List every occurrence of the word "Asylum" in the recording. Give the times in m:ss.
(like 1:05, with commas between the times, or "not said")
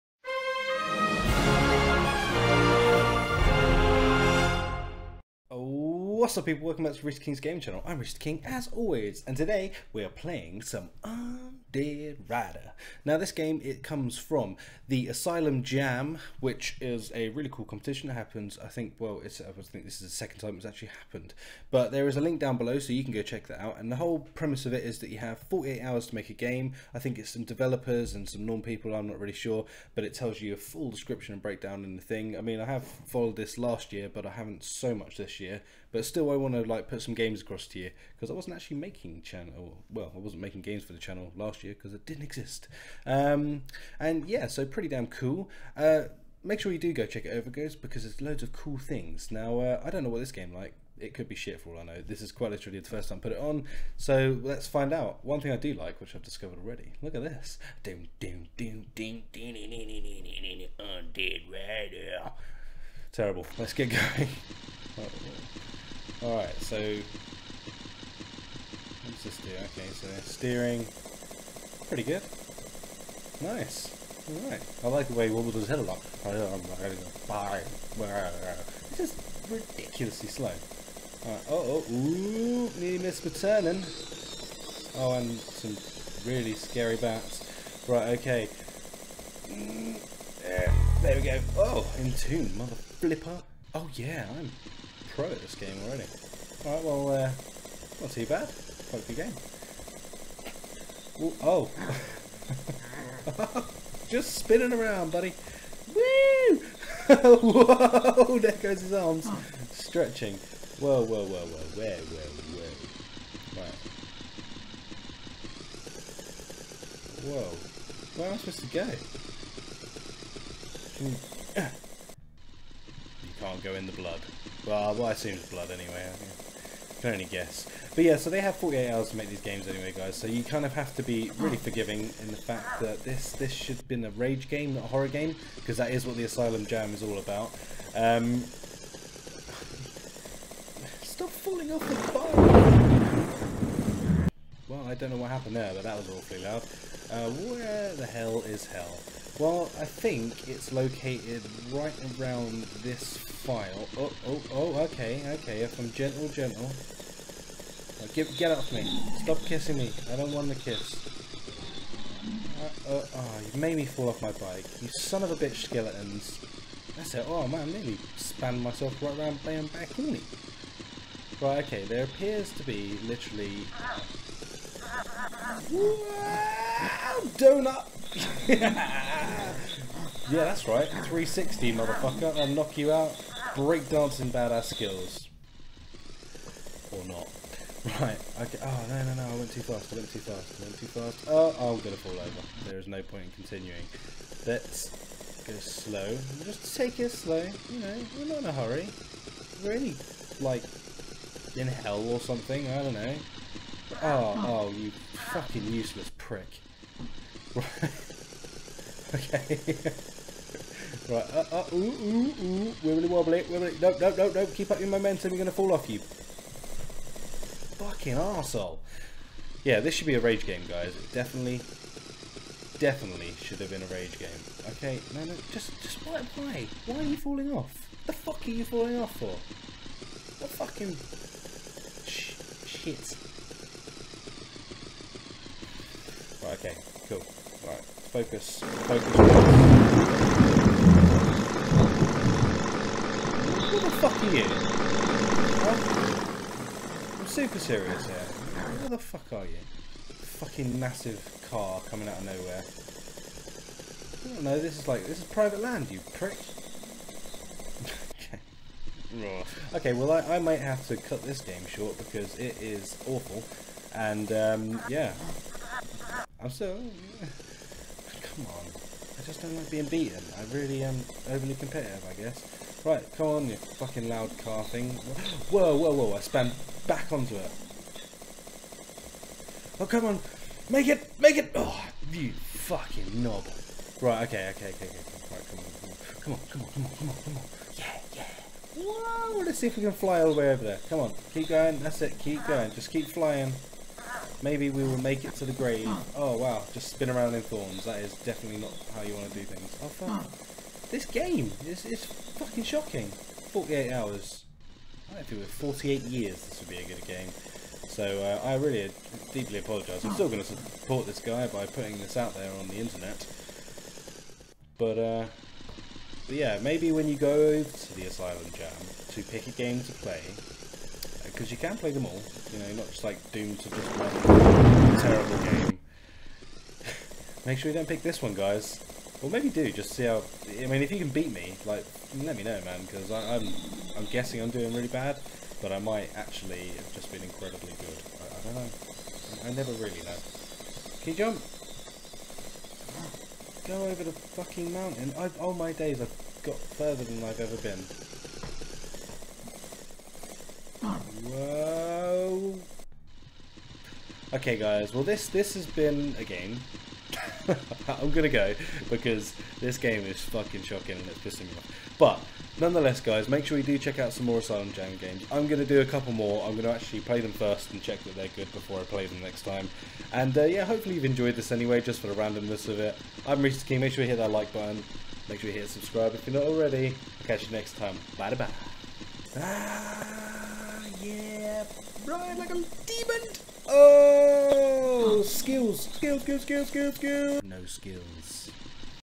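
0:15, 2:16, 5:18, 6:04.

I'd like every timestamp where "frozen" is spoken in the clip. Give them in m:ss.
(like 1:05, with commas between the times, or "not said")
not said.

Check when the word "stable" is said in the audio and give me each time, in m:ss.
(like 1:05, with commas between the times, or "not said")
not said.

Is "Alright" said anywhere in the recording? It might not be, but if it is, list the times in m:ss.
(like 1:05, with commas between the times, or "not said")
1:06, 1:14, 1:21, 1:36.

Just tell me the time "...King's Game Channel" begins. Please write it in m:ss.
0:07.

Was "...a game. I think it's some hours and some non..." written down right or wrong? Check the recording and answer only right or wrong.
wrong.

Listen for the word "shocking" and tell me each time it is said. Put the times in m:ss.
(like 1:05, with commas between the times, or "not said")
5:02, 6:00.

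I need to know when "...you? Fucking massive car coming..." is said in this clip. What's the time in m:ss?
4:09.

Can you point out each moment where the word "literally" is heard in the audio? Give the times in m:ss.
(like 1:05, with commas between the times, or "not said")
0:52, 2:53.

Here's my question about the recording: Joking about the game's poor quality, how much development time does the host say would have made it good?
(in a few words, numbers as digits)
48 years.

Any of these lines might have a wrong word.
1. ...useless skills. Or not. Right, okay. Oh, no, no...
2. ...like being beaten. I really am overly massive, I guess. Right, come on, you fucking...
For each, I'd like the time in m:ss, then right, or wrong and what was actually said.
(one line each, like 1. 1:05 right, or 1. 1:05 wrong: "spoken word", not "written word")
1. 3:04 wrong: "badass", not "useless"
2. 4:29 wrong: "competitive", not "massive".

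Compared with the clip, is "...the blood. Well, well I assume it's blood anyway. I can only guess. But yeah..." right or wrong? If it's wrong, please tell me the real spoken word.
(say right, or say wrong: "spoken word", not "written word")
right.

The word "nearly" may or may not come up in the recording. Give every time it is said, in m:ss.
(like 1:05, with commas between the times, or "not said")
1:22, 2:47.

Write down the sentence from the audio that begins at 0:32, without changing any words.
I mean, I have followed this last year, but I haven't so much this year.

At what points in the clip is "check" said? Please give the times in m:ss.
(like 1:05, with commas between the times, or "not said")
0:23, 0:47, 6:03, 6:07.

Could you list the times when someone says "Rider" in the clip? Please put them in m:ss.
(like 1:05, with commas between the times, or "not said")
0:12, 1:01.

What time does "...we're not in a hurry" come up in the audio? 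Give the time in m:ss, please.
3:18.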